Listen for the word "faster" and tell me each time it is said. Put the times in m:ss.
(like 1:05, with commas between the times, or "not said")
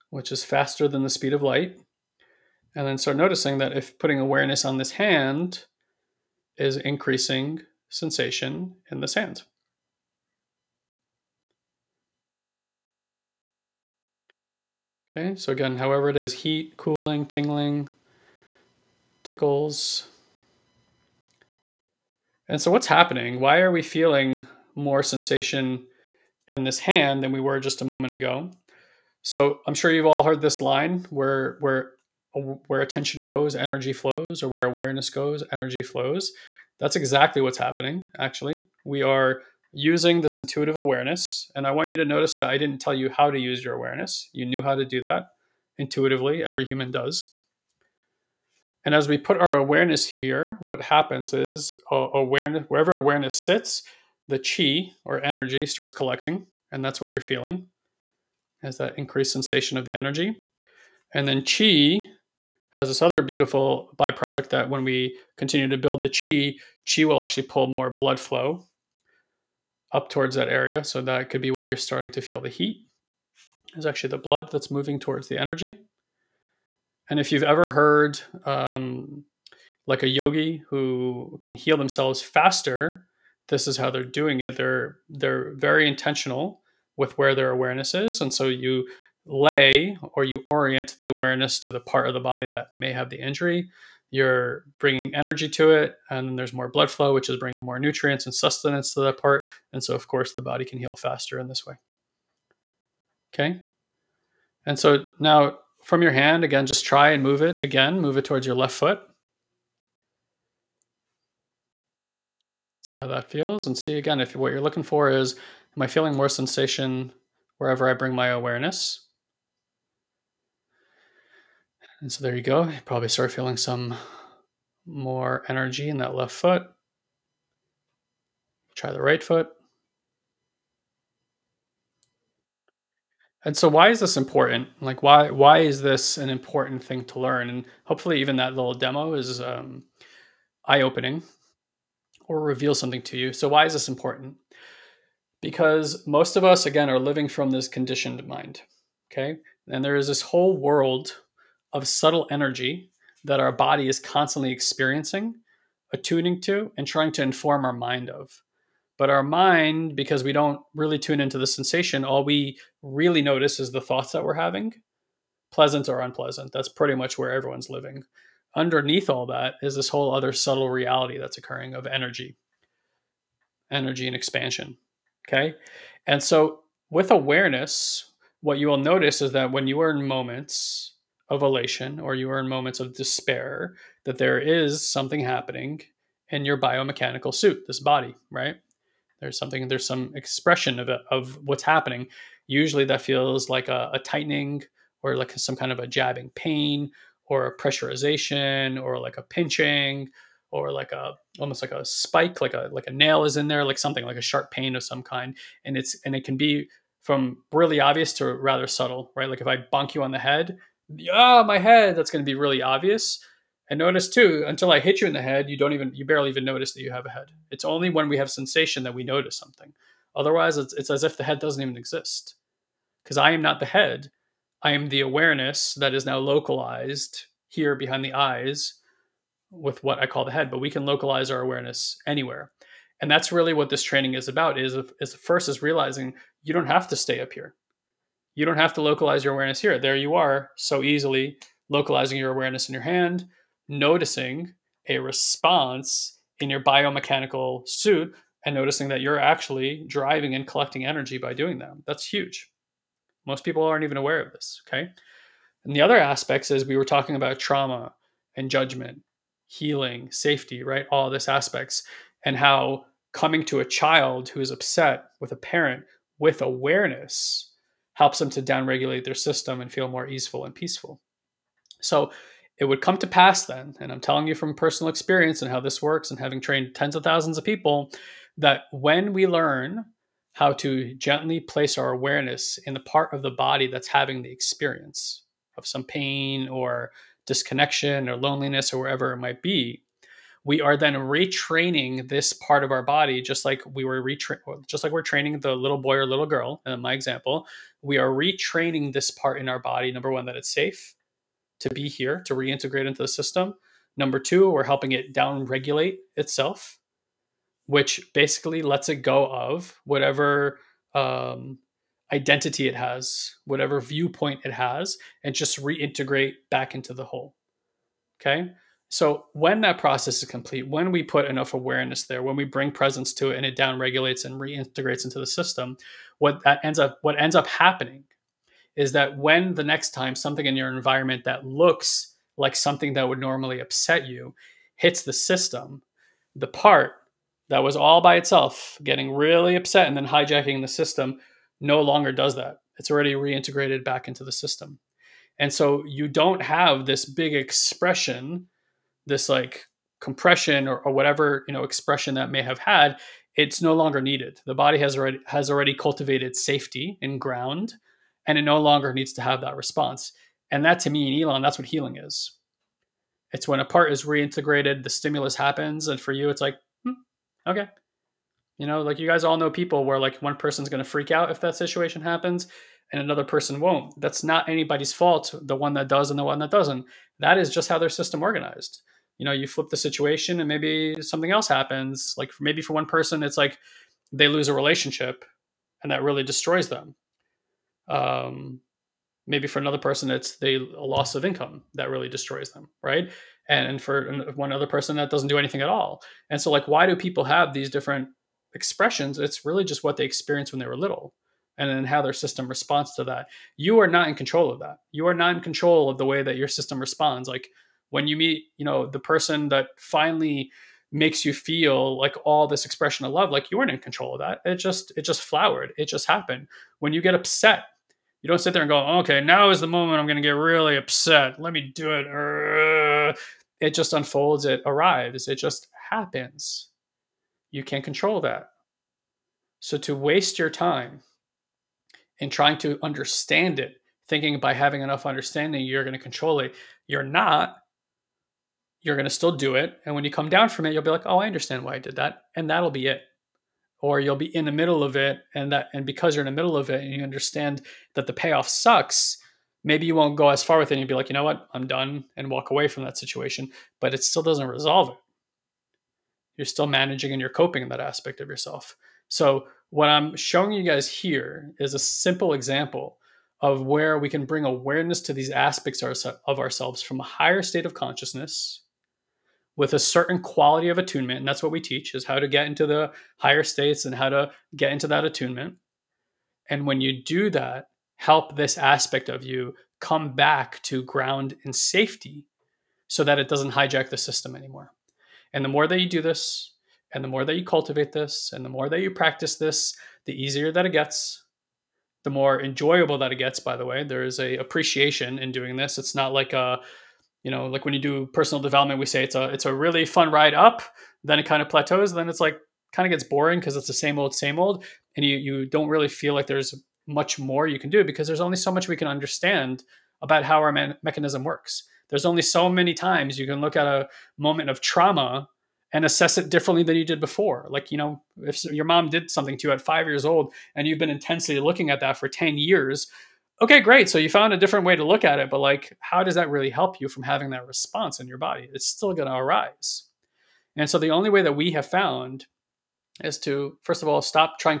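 0:00, 1:22, 1:40.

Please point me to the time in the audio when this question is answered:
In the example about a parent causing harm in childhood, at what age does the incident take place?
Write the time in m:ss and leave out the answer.
8:39.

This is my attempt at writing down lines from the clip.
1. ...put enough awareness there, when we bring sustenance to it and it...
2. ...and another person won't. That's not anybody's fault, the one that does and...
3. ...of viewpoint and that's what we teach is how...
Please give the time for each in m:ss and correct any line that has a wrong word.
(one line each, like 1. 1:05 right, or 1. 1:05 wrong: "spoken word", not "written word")
1. 5:21 wrong: "presence", not "sustenance"
2. 6:12 right
3. 7:50 wrong: "attunement", not "viewpoint".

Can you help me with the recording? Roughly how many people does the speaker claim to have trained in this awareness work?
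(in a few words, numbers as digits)
tens of thousands.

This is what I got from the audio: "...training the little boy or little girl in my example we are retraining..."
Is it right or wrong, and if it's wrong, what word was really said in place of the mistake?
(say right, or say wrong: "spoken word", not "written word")
right.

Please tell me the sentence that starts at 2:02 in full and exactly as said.
You probably start feeling some more energy in that left foot.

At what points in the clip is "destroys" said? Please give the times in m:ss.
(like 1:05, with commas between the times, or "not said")
6:26, 6:32.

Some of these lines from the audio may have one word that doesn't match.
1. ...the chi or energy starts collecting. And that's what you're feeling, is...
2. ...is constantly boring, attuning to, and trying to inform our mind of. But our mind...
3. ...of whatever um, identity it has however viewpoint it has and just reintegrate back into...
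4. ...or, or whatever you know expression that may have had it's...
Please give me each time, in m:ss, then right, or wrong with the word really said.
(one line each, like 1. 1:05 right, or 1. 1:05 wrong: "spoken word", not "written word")
1. 0:54 right
2. 2:33 wrong: "experiencing", not "boring"
3. 5:09 wrong: "whatever", not "however"
4. 5:50 right.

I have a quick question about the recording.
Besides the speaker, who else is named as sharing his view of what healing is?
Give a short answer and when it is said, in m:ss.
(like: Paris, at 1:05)
Ilan, at 6:01.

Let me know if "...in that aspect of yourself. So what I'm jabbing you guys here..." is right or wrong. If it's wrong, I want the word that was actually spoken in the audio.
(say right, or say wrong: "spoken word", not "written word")
wrong: "showing", not "jabbing".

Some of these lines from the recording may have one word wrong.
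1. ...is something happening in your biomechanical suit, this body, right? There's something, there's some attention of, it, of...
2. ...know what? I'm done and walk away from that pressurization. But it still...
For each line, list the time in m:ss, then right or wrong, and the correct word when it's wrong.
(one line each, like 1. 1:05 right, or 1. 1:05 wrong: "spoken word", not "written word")
1. 3:04 wrong: "expression", not "attention"
2. 7:31 wrong: "situation", not "pressurization".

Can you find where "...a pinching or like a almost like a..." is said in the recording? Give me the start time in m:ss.
3:19.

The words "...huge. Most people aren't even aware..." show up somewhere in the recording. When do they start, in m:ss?
4:12.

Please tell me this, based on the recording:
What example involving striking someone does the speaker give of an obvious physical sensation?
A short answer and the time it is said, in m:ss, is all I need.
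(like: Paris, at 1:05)
bonk you on the head, at 3:29.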